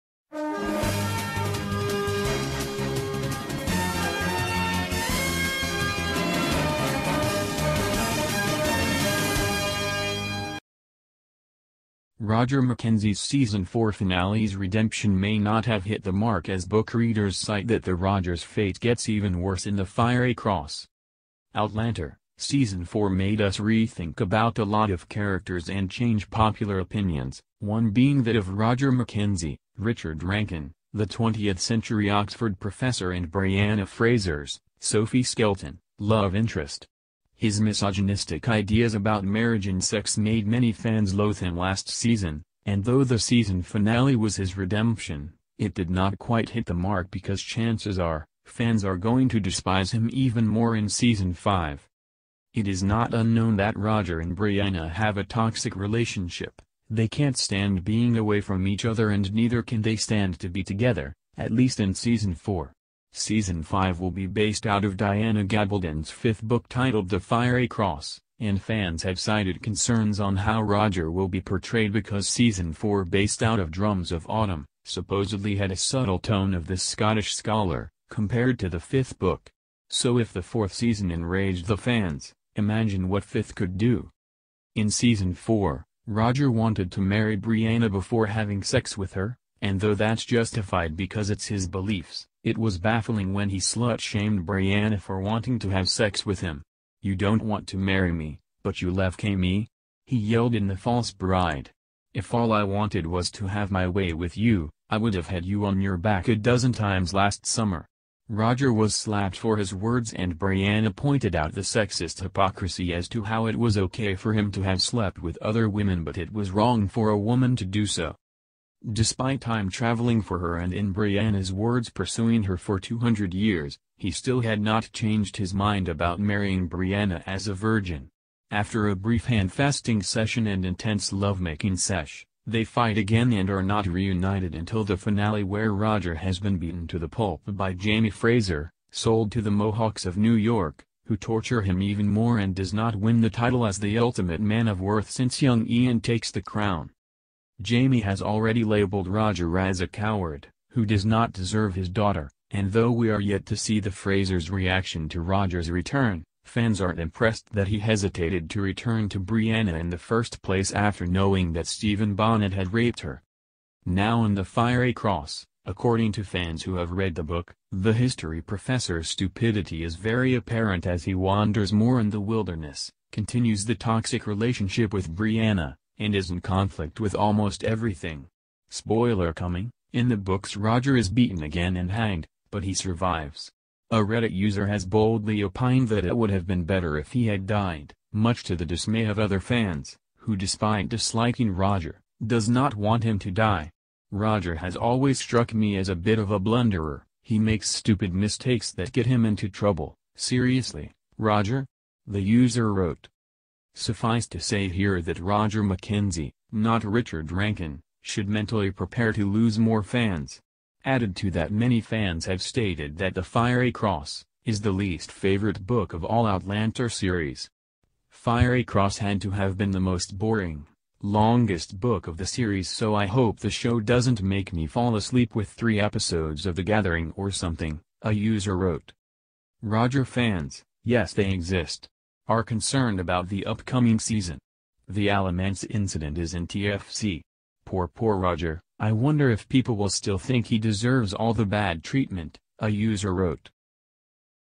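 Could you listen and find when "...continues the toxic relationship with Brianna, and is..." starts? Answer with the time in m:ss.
2:53.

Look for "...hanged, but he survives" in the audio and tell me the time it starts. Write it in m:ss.
3:01.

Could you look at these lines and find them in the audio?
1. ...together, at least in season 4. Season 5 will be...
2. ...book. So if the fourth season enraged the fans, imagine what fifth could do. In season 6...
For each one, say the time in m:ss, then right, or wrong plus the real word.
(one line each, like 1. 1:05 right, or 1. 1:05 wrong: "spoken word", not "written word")
1. 1:00 right
2. 1:19 wrong: "4", not "6".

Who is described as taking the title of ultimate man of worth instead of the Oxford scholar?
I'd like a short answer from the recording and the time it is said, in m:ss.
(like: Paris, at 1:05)
Young Ian, at 2:25.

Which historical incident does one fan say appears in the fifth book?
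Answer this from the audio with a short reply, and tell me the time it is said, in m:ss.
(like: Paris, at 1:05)
The Alamance incident, at 3:54.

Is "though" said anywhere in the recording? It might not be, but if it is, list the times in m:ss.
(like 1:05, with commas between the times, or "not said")
0:42, 1:29, 2:32.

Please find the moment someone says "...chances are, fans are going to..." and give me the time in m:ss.
0:47.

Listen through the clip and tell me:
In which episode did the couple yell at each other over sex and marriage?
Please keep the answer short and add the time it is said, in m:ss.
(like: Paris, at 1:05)
The False Bride, at 1:40.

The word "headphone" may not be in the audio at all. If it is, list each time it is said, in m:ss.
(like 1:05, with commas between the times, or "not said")
not said.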